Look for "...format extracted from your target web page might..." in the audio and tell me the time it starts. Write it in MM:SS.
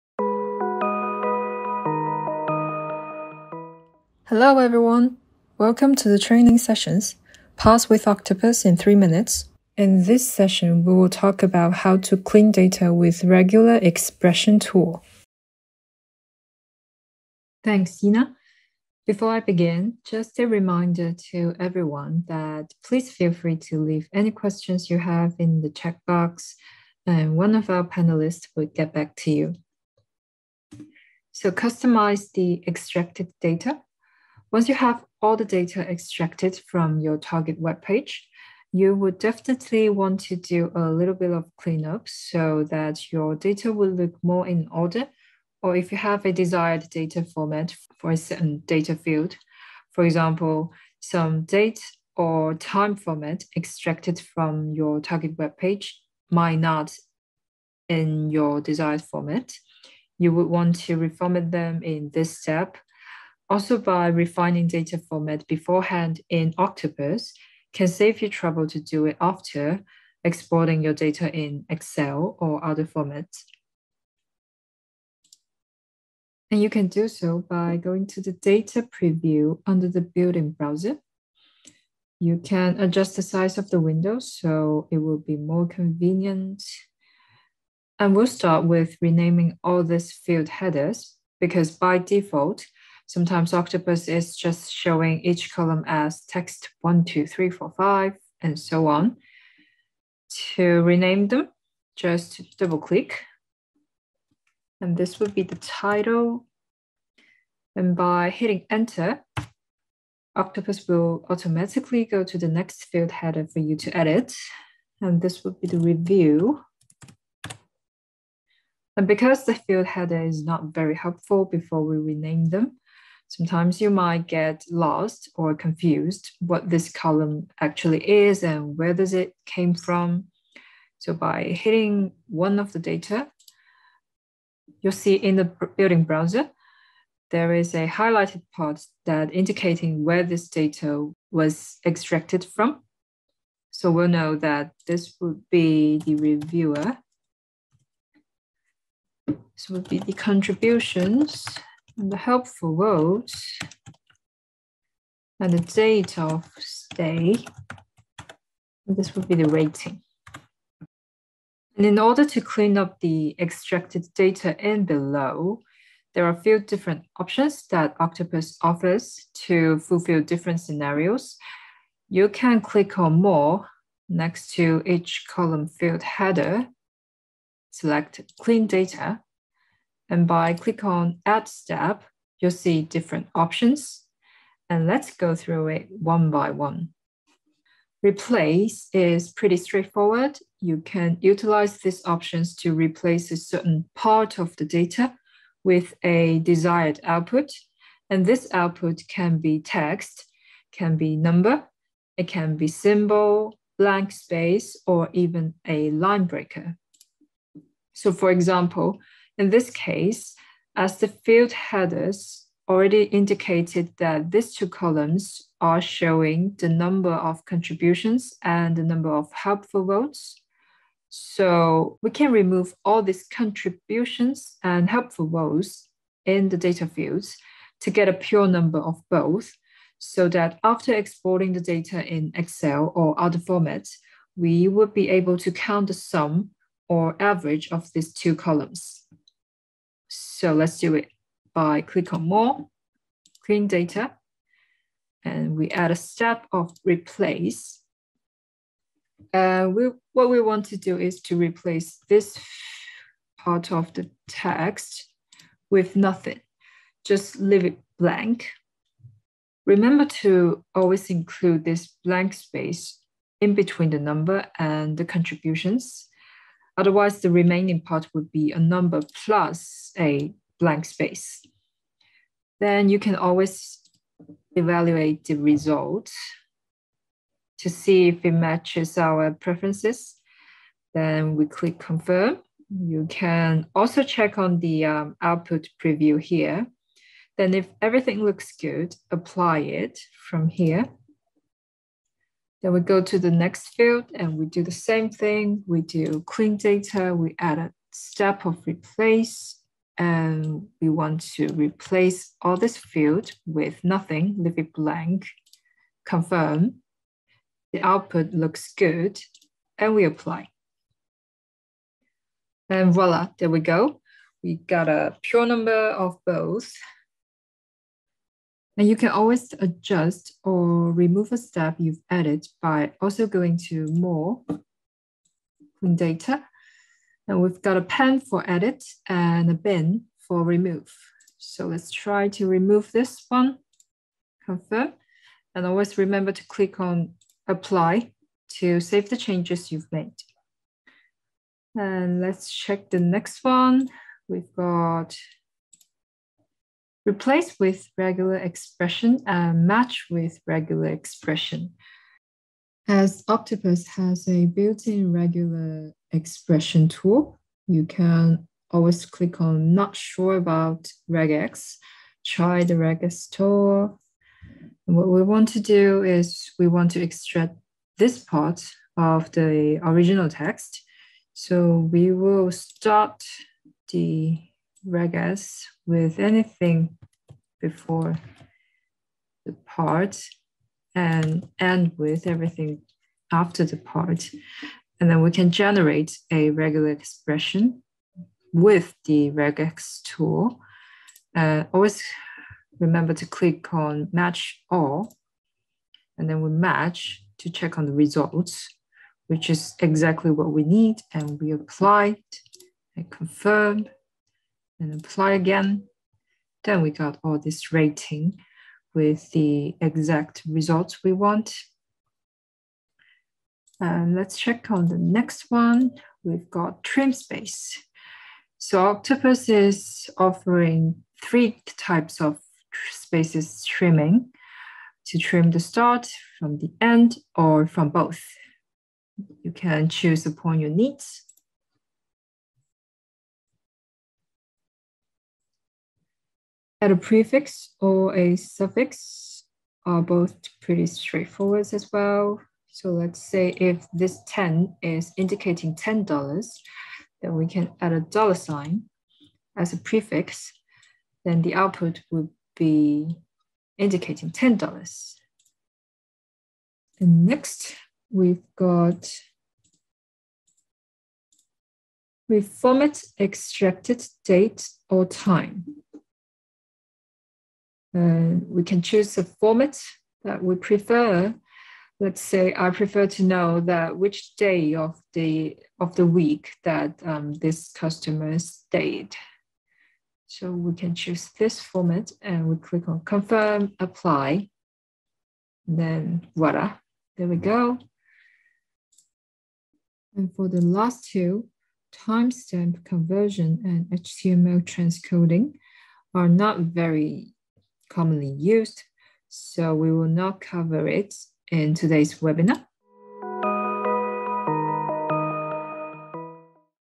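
00:52.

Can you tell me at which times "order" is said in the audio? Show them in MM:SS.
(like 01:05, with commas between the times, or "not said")
00:44, 02:41.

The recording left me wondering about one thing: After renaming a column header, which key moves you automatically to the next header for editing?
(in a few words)
Enter.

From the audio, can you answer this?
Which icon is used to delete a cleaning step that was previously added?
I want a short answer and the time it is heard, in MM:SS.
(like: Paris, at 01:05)
a bin, at 05:29.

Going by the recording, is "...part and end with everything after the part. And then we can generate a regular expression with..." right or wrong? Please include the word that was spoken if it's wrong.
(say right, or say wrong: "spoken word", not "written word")
right.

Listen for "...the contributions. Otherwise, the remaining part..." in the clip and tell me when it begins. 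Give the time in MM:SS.
04:24.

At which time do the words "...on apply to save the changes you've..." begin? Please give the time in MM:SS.
05:36.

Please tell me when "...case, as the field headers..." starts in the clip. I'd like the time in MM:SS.
03:29.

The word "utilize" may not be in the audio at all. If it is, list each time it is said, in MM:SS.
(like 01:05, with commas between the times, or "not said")
03:11.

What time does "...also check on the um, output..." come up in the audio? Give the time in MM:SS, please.
04:43.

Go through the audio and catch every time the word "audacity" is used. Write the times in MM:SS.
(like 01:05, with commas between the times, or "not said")
not said.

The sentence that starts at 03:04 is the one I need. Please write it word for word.
And let's go through it one by one.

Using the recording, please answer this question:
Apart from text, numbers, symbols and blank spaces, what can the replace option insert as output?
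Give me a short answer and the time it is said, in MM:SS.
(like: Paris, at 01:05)
a line breaker, at 03:25.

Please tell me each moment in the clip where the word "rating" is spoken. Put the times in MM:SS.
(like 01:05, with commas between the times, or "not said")
02:39, 06:47.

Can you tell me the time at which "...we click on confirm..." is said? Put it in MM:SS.
08:02.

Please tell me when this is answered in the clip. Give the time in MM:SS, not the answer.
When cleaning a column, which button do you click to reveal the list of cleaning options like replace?
03:01.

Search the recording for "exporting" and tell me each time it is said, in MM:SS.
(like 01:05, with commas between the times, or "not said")
01:10, 03:50.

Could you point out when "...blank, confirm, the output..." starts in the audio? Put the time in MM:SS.
05:04.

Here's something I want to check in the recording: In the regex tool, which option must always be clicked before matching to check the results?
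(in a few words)
match all.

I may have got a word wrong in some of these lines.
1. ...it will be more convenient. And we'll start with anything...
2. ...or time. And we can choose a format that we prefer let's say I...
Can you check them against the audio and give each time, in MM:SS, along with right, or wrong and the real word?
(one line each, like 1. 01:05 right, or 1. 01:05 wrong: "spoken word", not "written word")
1. 01:24 wrong: "renaming", not "anything"
2. 07:44 right.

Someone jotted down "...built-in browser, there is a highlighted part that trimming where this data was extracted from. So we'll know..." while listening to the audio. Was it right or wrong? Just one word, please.
wrong.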